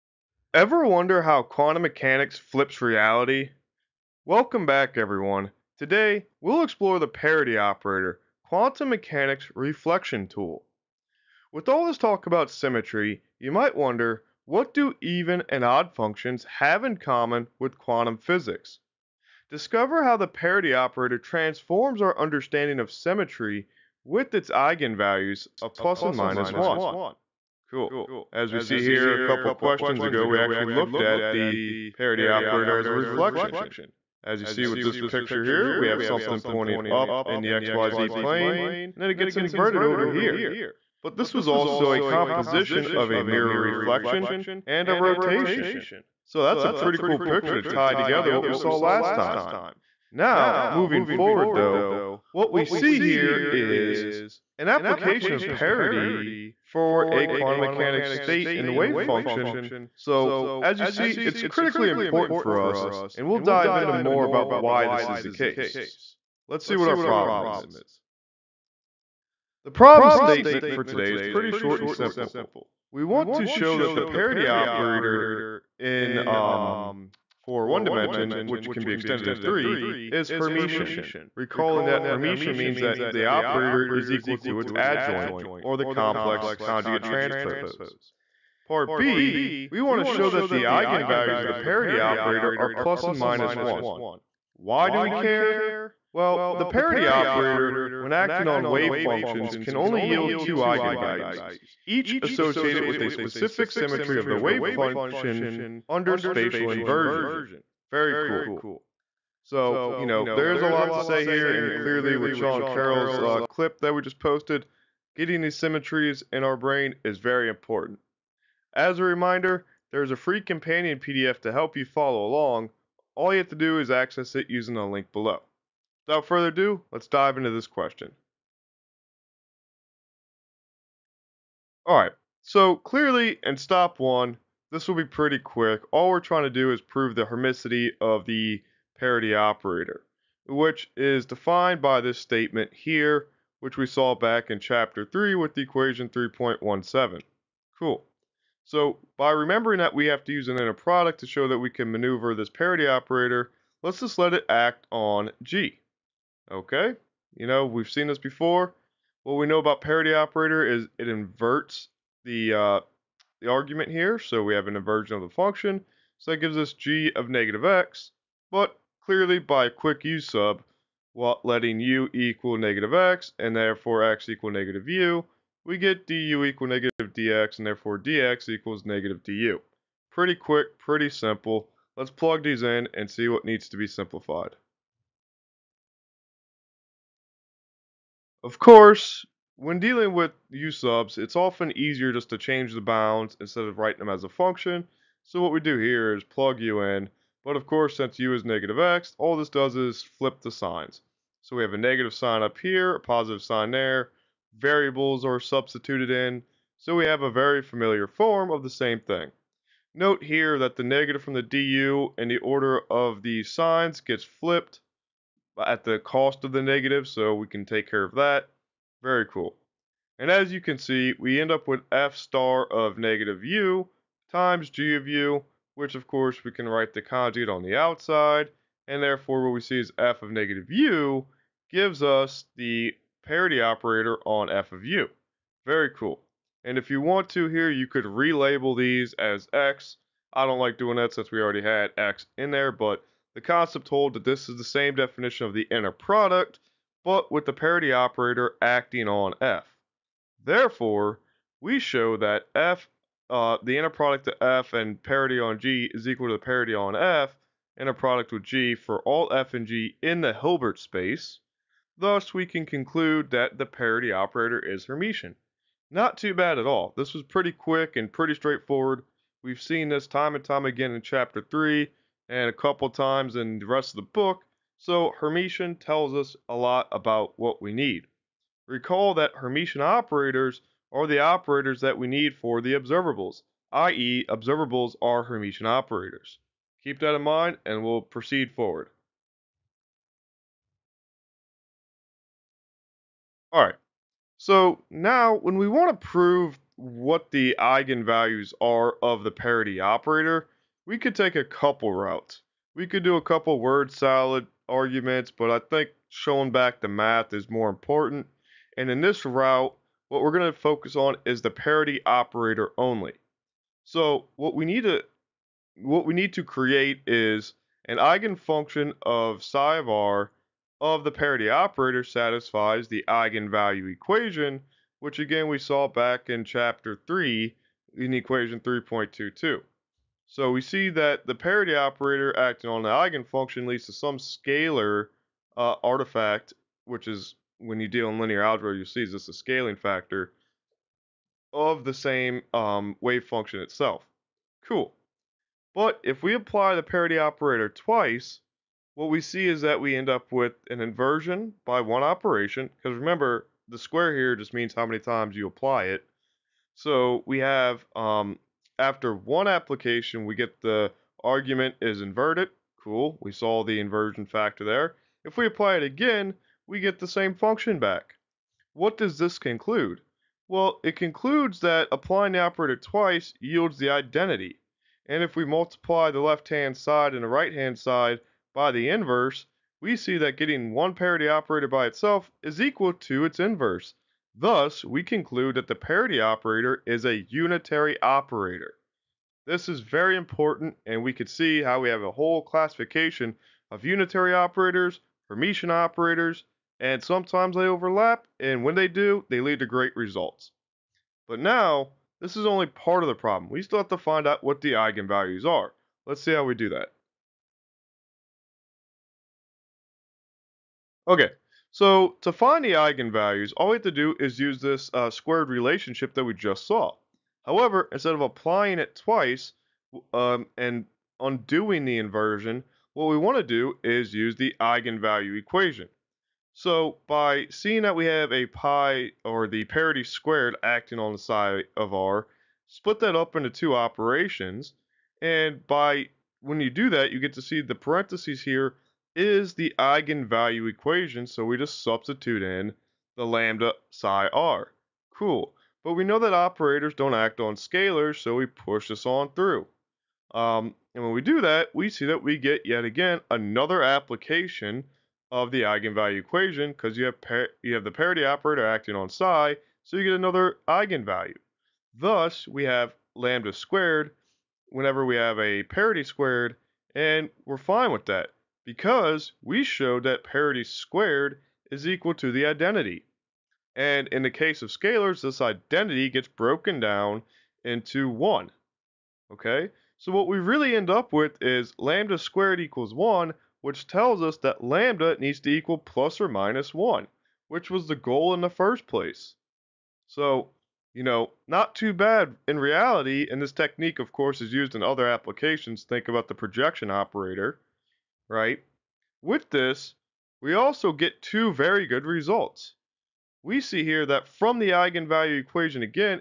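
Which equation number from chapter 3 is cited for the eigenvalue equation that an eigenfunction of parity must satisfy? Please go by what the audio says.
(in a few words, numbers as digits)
3.22.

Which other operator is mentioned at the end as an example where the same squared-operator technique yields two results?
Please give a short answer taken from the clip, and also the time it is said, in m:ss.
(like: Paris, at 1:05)
projection operator, at 8:16.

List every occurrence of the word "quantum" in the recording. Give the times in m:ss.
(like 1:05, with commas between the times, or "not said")
0:01, 0:08, 0:17, 0:57.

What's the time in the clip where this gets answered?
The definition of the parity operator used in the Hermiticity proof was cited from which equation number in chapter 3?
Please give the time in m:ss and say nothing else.
2:26.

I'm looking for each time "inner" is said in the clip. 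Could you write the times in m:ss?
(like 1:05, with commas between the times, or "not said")
2:30, 4:05, 4:13, 4:17.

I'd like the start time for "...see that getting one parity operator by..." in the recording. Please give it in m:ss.
6:19.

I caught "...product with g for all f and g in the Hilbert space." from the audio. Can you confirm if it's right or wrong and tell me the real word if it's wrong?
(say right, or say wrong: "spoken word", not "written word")
right.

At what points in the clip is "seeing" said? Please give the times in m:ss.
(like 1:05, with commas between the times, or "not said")
7:07.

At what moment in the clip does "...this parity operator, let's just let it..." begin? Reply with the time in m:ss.
2:32.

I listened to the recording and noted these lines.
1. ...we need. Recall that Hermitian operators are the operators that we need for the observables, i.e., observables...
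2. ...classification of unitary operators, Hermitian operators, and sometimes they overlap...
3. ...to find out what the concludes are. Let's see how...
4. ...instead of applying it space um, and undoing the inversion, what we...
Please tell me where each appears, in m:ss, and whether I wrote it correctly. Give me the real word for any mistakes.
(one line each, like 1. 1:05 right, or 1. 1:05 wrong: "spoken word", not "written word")
1. 4:37 right
2. 6:32 right
3. 6:43 wrong: "eigenvalues", not "concludes"
4. 6:57 wrong: "twice", not "space".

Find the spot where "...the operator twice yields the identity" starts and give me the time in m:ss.
6:12.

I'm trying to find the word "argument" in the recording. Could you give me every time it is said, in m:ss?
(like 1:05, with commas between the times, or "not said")
2:43, 5:04, 6:01.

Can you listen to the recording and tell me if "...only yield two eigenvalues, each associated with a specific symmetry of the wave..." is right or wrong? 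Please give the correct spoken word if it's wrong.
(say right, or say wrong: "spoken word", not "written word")
right.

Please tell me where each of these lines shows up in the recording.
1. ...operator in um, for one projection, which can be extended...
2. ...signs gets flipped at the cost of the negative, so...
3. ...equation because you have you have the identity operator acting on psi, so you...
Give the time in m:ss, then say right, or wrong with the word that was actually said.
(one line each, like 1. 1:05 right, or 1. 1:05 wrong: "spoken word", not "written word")
1. 1:14 wrong: "dimension", not "projection"
2. 3:33 right
3. 7:36 wrong: "parity", not "identity".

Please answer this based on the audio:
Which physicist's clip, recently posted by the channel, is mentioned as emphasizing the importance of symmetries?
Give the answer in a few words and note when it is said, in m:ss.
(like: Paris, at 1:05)
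Sean Carroll, at 1:52.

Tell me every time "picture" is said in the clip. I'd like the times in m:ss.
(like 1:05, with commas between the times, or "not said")
0:34, 0:47.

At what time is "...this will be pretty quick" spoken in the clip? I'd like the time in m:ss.
2:14.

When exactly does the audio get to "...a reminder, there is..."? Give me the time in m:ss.
1:58.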